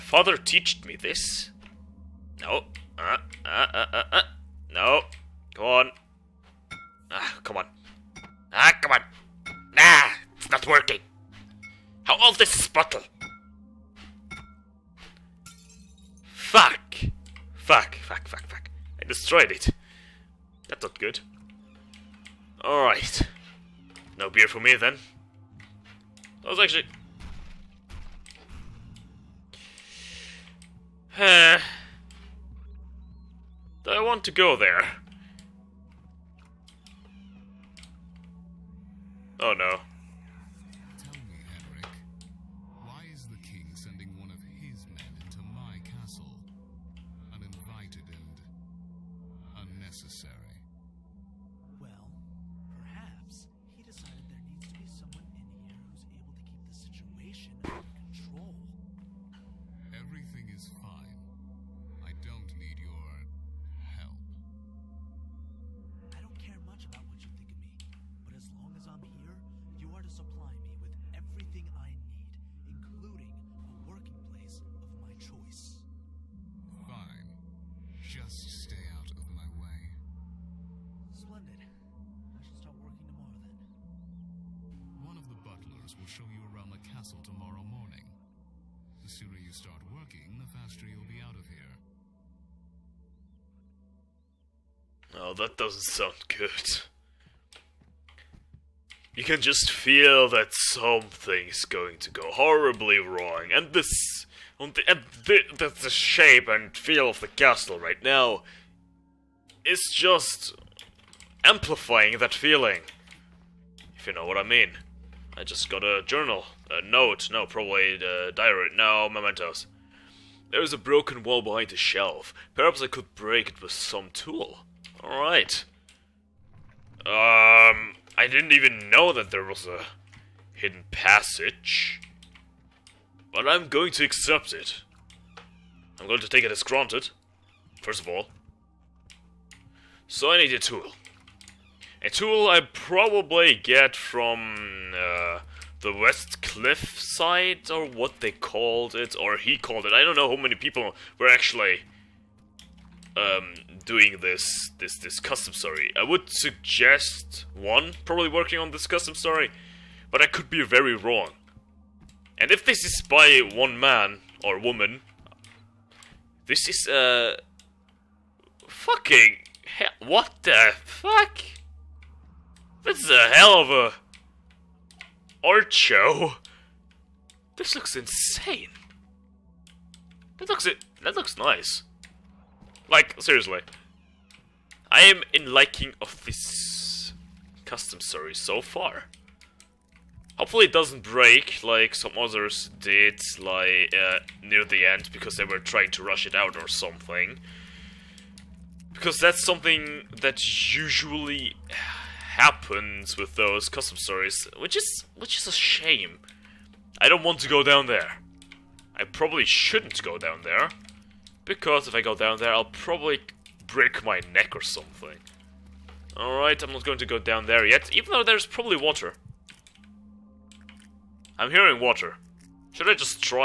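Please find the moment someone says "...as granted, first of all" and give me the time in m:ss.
2:16.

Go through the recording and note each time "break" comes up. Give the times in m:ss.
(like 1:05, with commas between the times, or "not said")
2:03, 3:11, 3:33.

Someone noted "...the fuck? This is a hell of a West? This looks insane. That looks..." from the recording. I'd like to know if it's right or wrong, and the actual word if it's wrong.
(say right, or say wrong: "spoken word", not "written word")
wrong: "Archo", not "West".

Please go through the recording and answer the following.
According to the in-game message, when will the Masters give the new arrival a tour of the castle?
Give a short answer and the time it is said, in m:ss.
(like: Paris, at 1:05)
Tomorrow morning, at 1:27.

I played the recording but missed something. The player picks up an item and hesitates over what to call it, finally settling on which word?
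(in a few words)
Mementos.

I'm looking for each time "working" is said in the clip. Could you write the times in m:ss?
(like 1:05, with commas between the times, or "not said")
0:10, 1:29, 2:38.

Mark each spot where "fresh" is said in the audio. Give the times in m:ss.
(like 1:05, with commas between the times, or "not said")
not said.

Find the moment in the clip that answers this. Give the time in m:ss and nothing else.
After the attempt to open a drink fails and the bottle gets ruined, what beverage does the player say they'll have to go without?
0:24.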